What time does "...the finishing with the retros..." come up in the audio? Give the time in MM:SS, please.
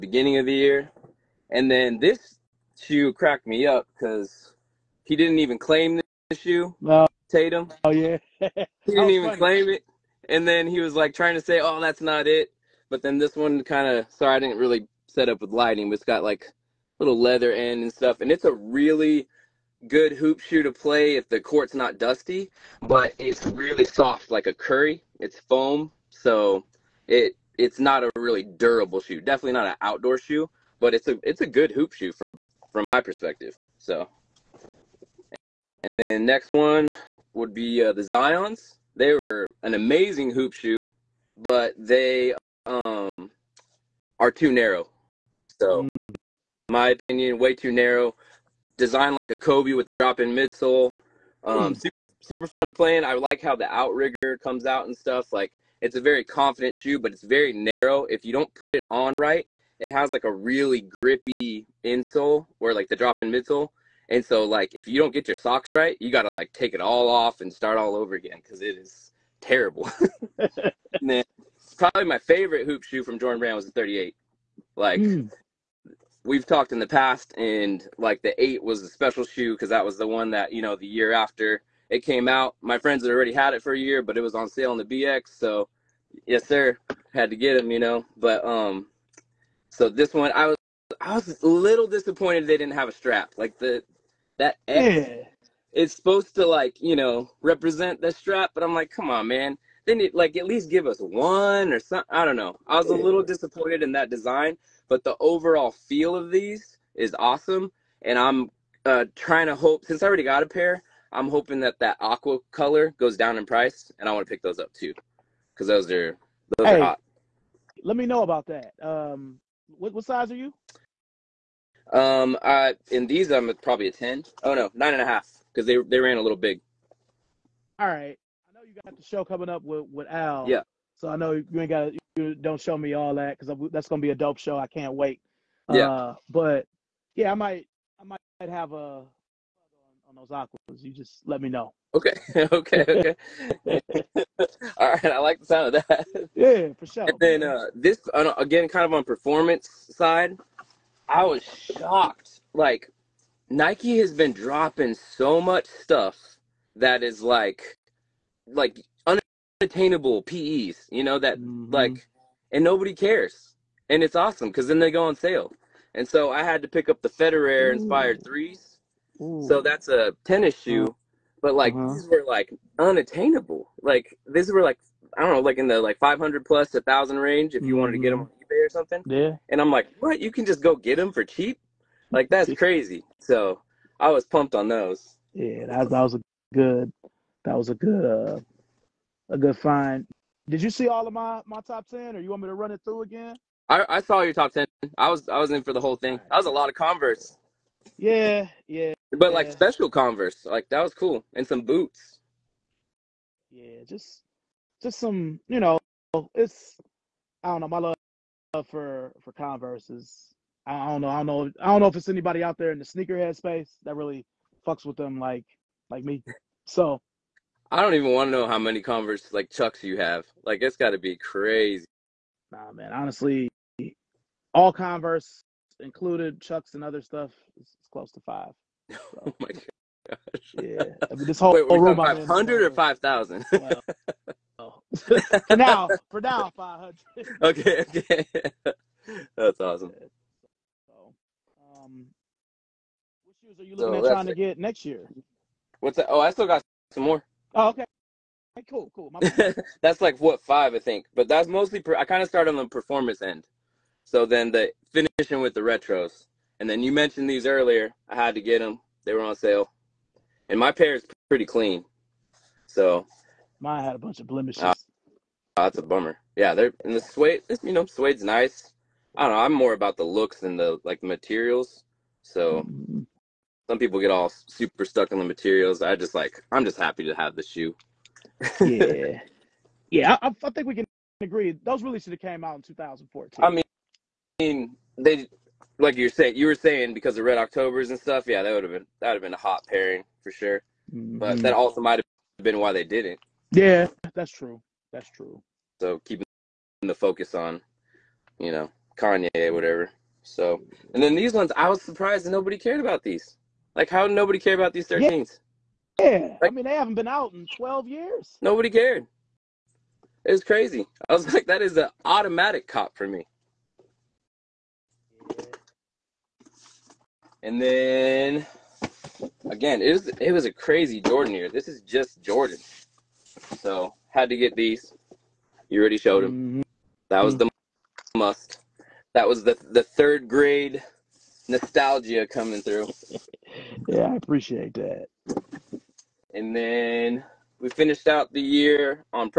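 04:14.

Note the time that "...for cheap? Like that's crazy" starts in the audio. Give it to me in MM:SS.
03:01.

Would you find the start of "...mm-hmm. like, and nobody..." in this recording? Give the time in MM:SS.
02:41.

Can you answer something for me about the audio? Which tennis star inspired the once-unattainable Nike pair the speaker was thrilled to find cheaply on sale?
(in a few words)
Federer.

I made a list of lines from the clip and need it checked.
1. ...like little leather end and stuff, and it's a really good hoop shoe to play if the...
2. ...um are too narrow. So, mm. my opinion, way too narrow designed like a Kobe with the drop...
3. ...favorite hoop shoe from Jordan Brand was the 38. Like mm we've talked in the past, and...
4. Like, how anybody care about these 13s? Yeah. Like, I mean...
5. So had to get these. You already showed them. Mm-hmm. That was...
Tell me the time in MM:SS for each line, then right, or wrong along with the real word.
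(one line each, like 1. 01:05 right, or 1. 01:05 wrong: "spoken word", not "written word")
1. 00:16 right
2. 00:42 right
3. 01:12 right
4. 05:03 wrong: "nobody", not "anybody"
5. 05:23 right.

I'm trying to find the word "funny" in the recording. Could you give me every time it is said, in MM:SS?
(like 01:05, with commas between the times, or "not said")
00:09.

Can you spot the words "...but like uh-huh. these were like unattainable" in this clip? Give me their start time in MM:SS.
02:51.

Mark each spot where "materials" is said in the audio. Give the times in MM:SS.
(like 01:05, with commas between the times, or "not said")
04:31, 04:35.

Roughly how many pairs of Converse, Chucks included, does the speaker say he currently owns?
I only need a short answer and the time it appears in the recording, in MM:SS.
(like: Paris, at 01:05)
500, at 03:56.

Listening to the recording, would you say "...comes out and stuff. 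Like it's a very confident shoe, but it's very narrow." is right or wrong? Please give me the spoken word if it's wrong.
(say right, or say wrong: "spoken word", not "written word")
right.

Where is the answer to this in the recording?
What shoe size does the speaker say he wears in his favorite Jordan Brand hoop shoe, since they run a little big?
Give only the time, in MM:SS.
02:04.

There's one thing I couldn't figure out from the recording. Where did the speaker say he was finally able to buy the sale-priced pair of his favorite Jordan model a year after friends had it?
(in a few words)
The BX.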